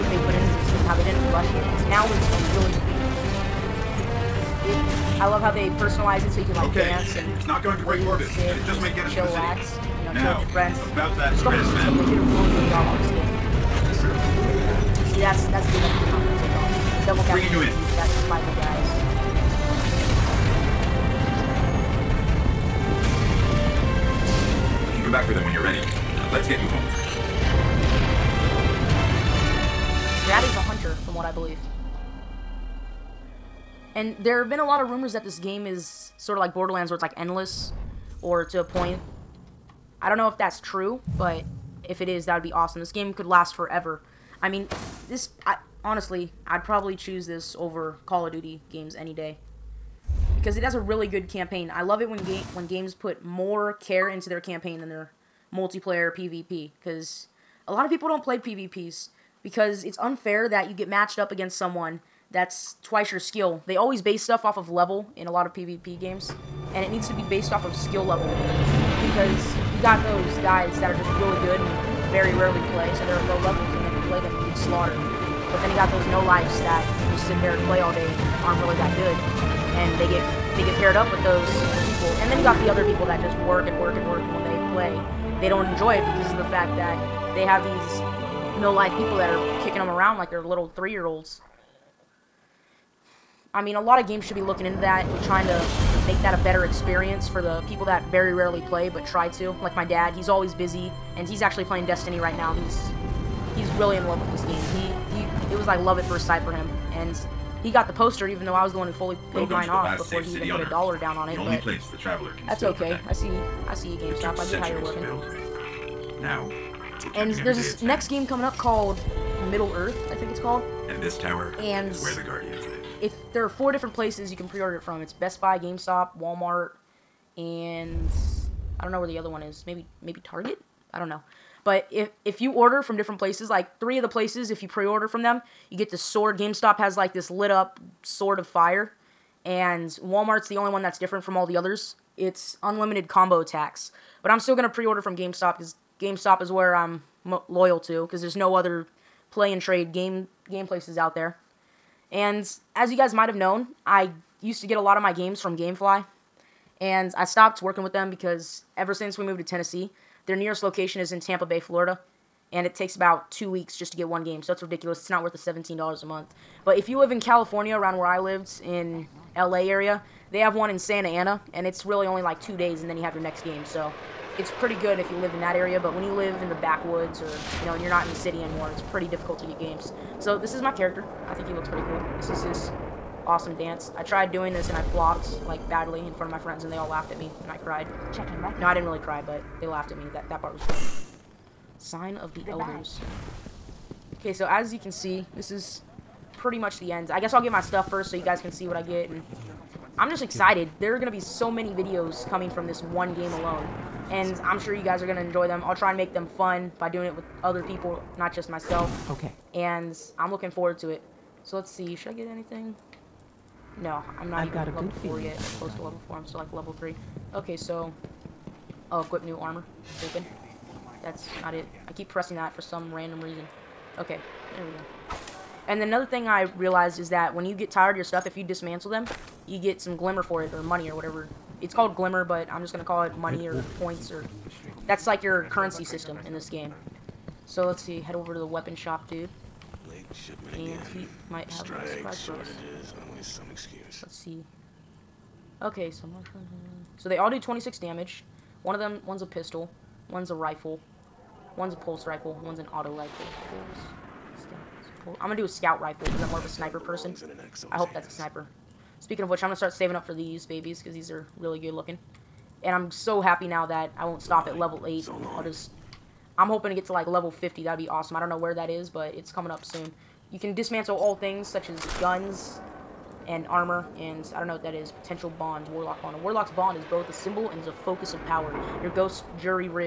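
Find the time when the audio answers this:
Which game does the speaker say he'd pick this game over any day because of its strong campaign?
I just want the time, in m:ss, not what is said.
0:48.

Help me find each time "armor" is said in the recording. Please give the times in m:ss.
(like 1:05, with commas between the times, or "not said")
3:39, 4:33.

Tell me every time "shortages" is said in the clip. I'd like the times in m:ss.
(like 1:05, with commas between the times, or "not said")
4:02.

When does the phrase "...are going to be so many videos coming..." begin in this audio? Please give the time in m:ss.
3:20.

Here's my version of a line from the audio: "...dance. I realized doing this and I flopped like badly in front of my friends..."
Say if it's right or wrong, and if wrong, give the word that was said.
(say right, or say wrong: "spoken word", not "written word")
wrong: "tried", not "realized".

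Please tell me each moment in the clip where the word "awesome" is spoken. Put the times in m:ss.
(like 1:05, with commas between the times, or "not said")
0:42, 3:03, 4:27.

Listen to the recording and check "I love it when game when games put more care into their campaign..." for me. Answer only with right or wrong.
right.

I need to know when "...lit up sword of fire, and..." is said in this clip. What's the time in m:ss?
2:17.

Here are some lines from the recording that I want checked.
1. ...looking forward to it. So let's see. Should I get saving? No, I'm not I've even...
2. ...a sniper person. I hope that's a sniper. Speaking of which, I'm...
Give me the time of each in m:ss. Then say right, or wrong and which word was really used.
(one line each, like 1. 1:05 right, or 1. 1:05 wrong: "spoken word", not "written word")
1. 3:30 wrong: "anything", not "saving"
2. 4:16 right.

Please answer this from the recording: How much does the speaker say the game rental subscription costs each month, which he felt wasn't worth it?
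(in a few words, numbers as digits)
$17.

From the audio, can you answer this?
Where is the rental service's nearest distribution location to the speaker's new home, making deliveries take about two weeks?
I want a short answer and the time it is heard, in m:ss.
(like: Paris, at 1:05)
Tampa Bay, Florida, at 2:41.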